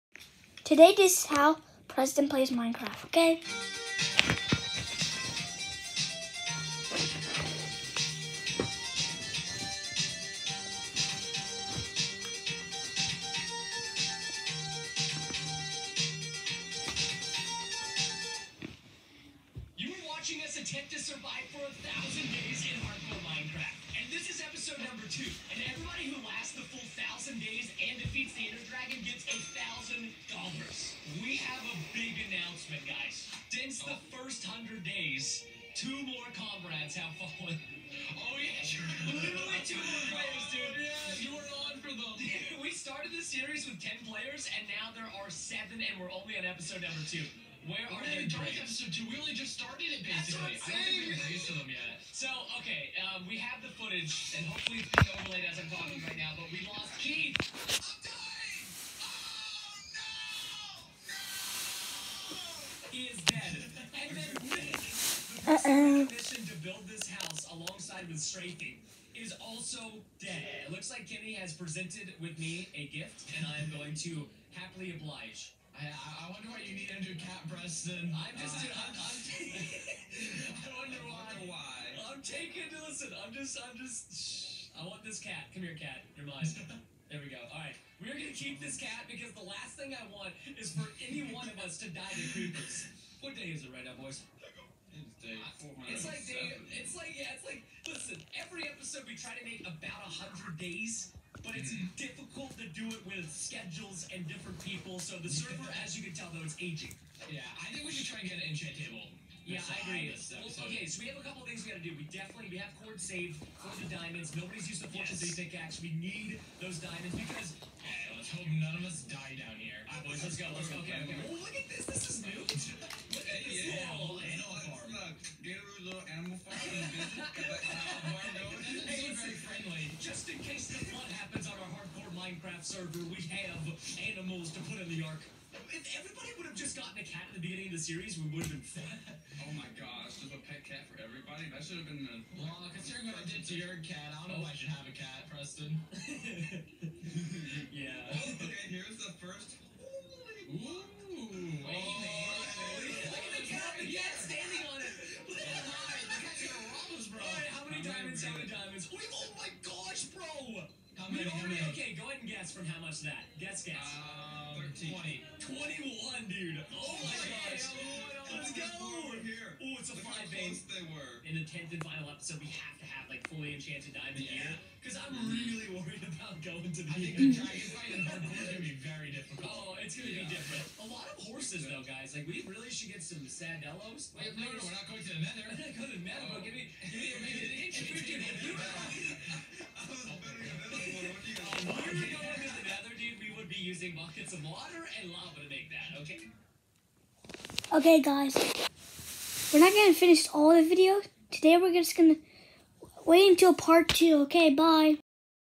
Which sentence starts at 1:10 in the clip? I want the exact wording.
It looks like Kenny has presented with me a gift, and I'm going to happily oblige.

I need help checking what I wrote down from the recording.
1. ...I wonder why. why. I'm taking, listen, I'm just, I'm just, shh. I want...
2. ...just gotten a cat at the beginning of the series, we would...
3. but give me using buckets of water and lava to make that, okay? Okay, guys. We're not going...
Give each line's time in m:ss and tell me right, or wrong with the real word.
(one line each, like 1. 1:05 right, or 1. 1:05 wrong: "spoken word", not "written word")
1. 1:20 right
2. 2:16 right
3. 3:06 right.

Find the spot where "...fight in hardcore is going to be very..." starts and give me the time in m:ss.
2:57.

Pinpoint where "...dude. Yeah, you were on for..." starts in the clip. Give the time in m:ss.
0:40.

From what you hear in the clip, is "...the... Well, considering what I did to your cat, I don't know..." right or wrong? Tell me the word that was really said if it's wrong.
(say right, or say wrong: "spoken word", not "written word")
right.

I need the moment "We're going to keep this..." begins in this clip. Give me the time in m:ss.
1:27.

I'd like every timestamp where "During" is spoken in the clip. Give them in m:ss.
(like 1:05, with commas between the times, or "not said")
0:48.